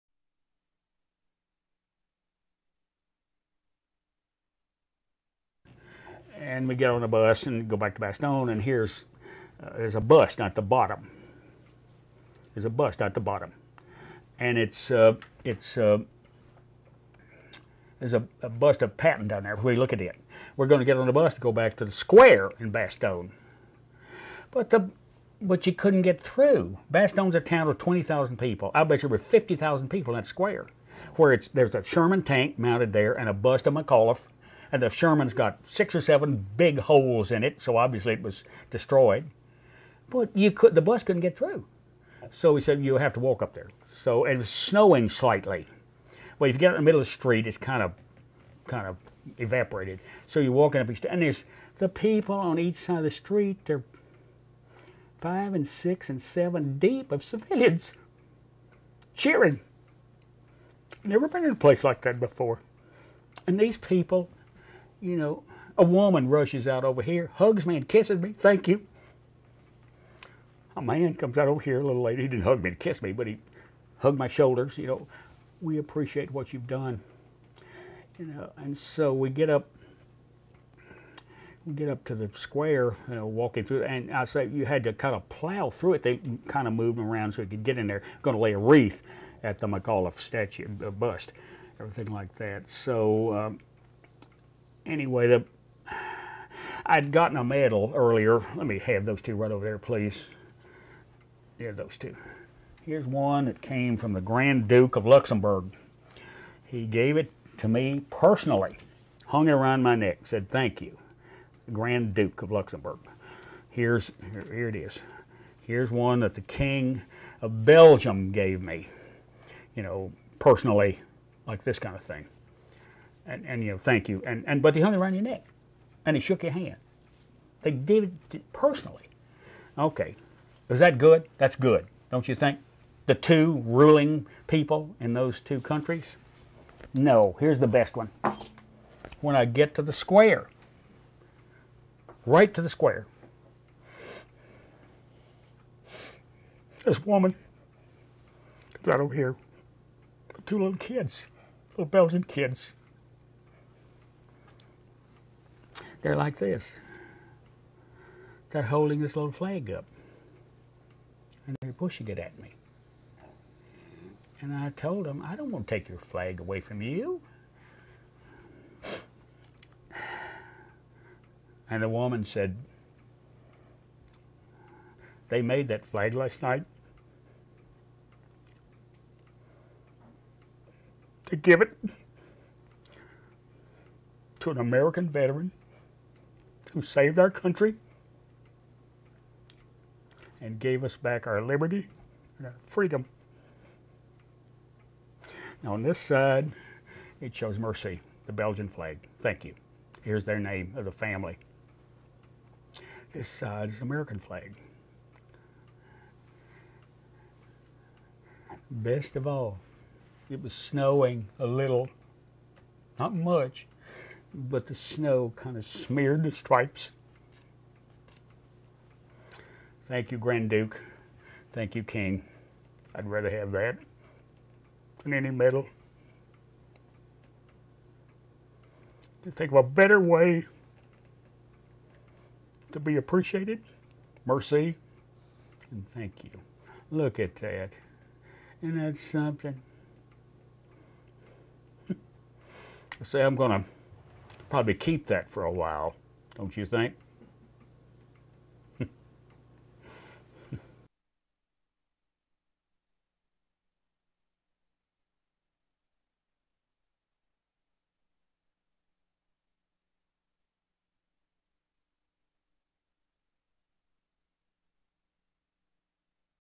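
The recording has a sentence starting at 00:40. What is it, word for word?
But you could the bus couldn't get through.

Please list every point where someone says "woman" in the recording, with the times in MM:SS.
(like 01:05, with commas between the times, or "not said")
01:05, 02:27, 02:51.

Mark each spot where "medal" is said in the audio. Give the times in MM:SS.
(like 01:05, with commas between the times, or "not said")
01:37, 03:45.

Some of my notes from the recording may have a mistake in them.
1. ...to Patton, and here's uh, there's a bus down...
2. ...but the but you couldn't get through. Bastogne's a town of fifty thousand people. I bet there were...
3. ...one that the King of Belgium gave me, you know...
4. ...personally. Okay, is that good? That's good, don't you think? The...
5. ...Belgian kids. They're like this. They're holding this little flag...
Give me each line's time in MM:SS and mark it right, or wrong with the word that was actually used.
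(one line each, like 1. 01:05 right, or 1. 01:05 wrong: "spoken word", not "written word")
1. 00:07 wrong: "Bastogne", not "Patton"
2. 00:24 wrong: "twenty", not "fifty"
3. 01:55 right
4. 02:08 right
5. 02:31 right.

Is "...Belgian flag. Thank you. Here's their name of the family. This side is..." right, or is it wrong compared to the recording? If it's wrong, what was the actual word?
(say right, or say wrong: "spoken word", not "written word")
right.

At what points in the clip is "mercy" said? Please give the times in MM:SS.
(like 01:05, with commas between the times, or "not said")
03:17, 03:54.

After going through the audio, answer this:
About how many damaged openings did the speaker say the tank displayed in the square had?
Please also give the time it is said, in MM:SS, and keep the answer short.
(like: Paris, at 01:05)
6 or 7, at 00:35.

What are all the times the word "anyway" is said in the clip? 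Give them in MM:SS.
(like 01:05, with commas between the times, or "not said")
01:34.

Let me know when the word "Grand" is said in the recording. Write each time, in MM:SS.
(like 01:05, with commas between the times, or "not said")
01:44, 01:51, 03:40.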